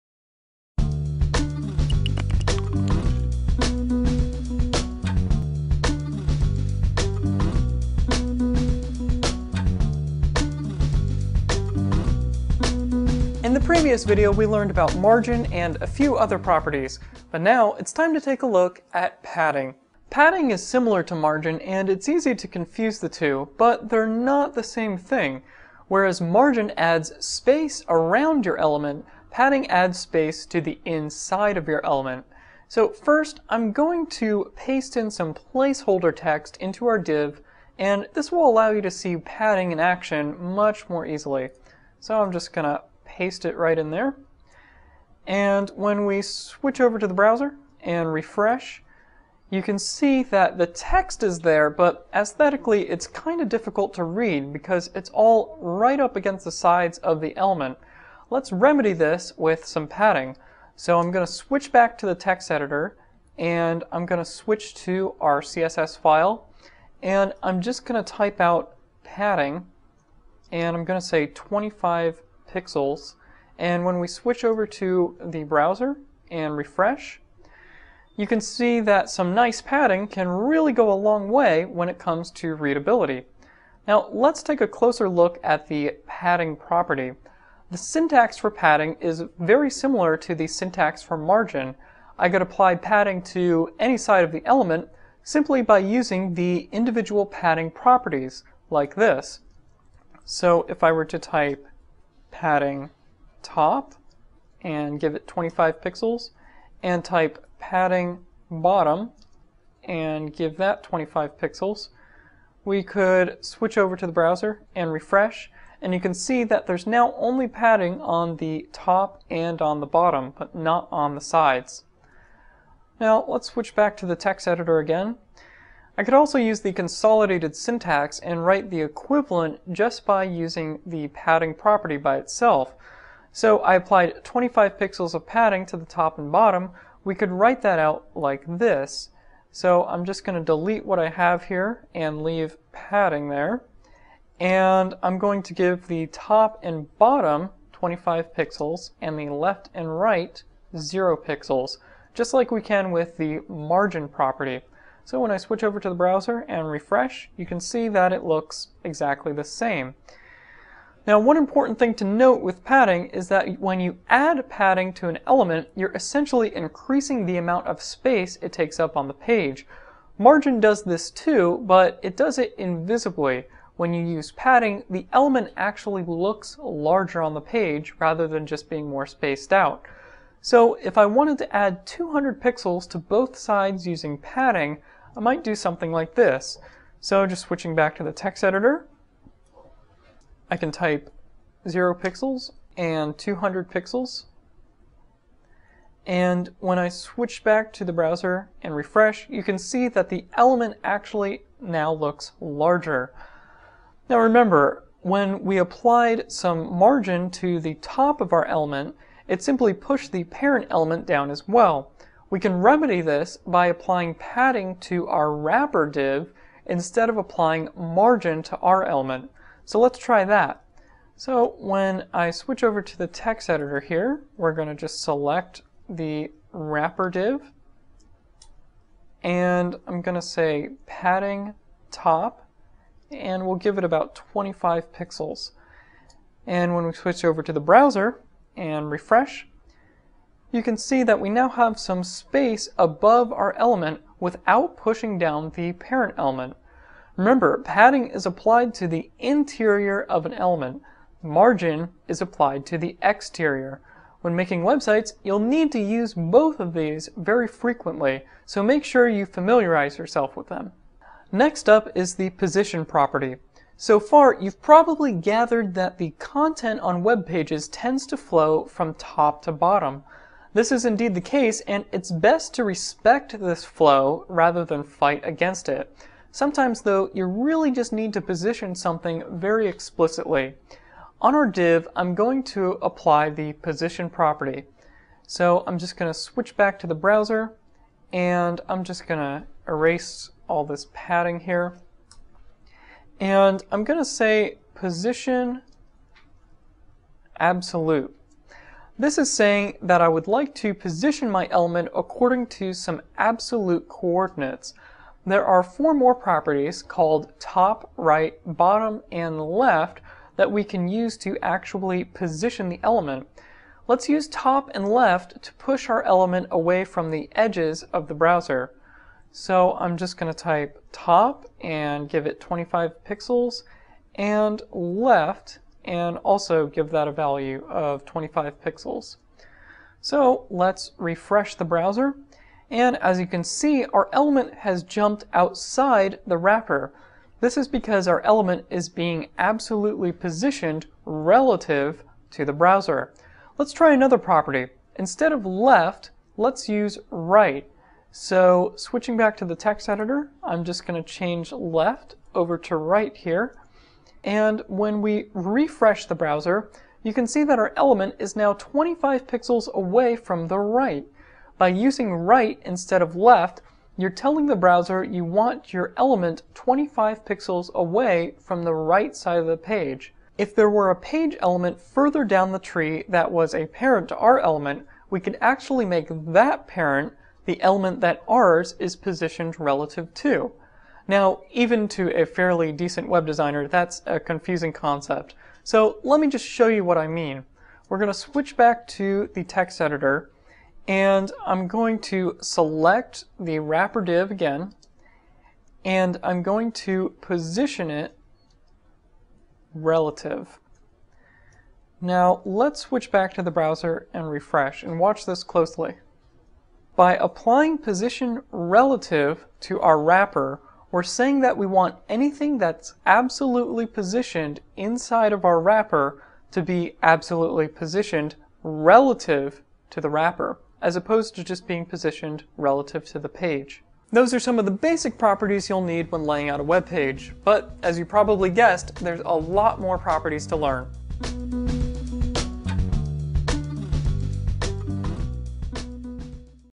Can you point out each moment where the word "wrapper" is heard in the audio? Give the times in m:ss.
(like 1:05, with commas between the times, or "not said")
3:35, 3:46, 5:36, 6:33, 6:50, 6:55, 7:00.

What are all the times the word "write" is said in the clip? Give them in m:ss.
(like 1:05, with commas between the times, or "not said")
2:08, 2:17.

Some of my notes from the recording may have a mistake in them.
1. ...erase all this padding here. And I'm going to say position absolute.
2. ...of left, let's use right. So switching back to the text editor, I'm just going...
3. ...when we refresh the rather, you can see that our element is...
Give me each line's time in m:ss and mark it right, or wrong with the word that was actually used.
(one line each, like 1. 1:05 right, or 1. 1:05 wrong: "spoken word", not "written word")
1. 4:49 right
2. 5:45 right
3. 5:54 wrong: "browser", not "rather".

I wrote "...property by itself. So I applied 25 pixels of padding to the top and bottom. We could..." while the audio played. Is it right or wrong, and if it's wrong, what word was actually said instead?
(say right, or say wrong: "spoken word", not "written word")
right.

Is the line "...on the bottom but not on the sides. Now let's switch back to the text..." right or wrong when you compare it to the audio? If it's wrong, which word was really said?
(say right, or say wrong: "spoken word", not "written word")
right.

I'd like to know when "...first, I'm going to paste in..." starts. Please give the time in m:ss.
0:32.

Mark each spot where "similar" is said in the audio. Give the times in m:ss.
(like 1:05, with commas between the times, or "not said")
0:20, 1:29.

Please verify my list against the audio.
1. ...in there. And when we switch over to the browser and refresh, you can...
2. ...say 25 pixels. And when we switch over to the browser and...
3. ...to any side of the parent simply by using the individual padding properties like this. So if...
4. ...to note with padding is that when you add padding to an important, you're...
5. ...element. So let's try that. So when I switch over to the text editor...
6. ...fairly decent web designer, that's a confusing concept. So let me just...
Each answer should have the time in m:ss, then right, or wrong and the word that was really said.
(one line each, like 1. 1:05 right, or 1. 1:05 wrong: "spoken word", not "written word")
1. 0:43 right
2. 1:11 right
3. 1:33 wrong: "element", not "parent"
4. 2:41 wrong: "element", not "important"
5. 3:38 right
6. 6:22 right.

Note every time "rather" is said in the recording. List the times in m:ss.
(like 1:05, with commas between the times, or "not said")
2:57, 4:34.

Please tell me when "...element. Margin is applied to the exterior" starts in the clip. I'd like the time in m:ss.
4:10.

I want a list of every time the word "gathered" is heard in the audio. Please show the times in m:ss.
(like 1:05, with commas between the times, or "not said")
4:25.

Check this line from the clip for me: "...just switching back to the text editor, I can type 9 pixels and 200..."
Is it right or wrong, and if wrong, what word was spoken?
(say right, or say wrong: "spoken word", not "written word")
wrong: "0", not "9".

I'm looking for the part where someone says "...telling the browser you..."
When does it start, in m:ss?
6:04.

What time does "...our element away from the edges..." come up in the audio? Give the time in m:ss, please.
5:15.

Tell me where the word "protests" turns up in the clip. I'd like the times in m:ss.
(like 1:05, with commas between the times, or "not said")
not said.